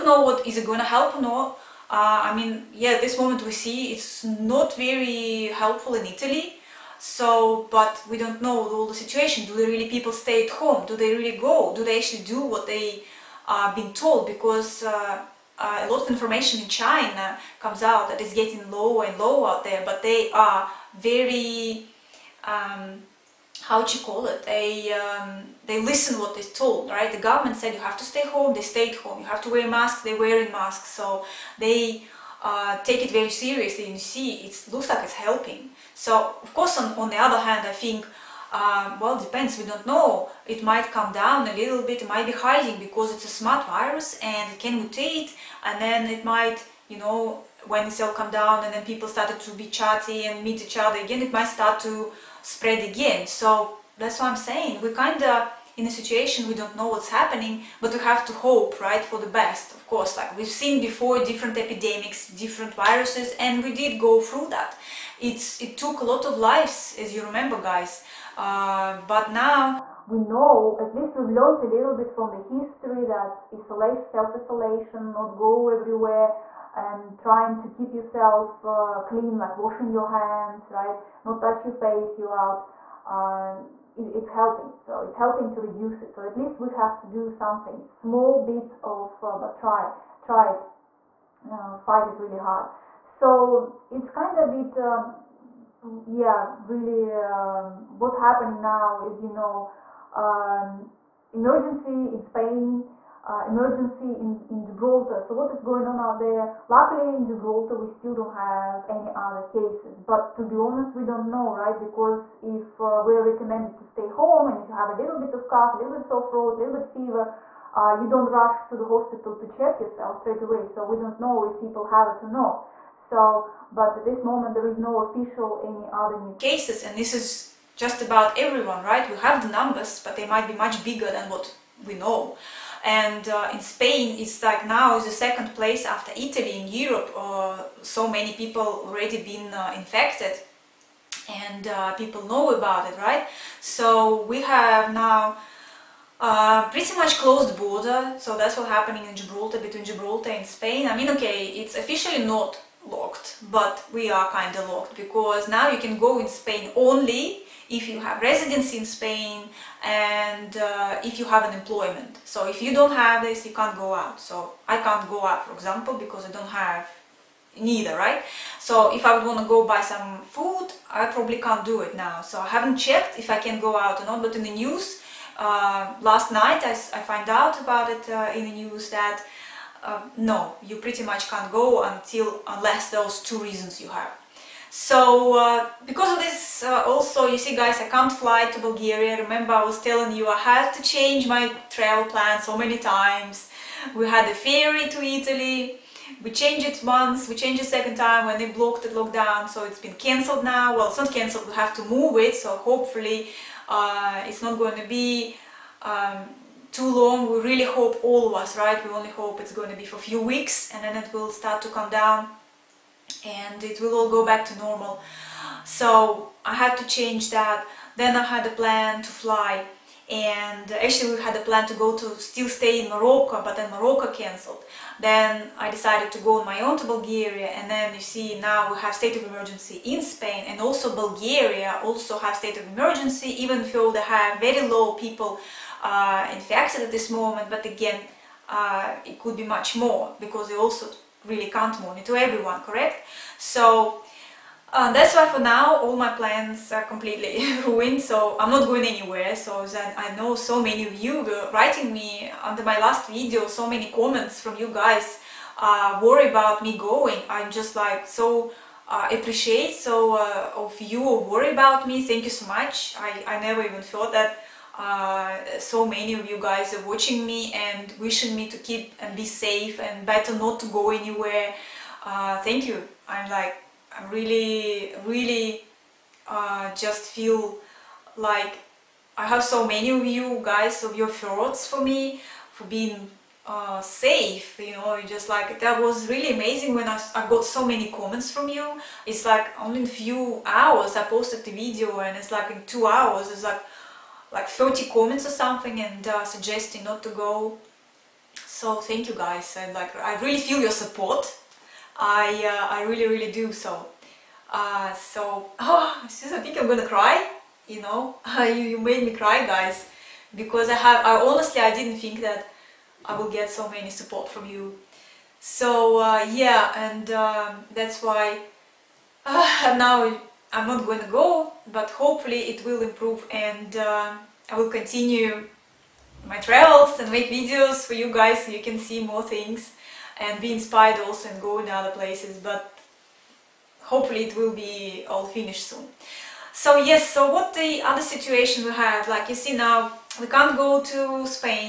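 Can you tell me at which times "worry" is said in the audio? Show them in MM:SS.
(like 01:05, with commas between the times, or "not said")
04:16, 04:21.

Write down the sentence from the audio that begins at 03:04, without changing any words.
So uh, because of this uh, also, you see guys, I can't fly to Bulgaria.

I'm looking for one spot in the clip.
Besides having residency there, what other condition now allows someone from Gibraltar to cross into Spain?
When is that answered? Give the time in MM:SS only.
02:41.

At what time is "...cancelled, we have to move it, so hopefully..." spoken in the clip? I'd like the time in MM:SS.
03:21.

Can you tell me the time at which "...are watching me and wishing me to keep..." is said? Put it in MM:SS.
04:26.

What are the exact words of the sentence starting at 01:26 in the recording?
So at least we have to do something, small bits of, uh, but try, try it, uh, fight it really hard.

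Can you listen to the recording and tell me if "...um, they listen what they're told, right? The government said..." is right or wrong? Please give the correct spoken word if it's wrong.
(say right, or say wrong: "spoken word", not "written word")
right.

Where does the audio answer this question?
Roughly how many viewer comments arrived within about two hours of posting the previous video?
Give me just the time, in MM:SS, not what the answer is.
04:54.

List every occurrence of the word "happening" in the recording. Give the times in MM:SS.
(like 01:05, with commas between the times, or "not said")
00:57, 01:38, 02:28.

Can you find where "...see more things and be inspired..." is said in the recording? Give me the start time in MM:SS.
05:28.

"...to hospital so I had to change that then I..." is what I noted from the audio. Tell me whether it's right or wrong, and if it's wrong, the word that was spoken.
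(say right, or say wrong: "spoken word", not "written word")
wrong: "normal", not "hospital".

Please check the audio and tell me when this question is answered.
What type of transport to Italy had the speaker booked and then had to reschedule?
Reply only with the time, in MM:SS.
03:14.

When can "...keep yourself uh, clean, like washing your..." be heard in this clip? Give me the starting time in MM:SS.
01:17.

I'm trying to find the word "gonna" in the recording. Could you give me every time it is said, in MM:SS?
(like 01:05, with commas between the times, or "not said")
00:00, 05:06.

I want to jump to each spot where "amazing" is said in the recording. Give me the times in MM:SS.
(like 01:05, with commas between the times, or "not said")
04:46.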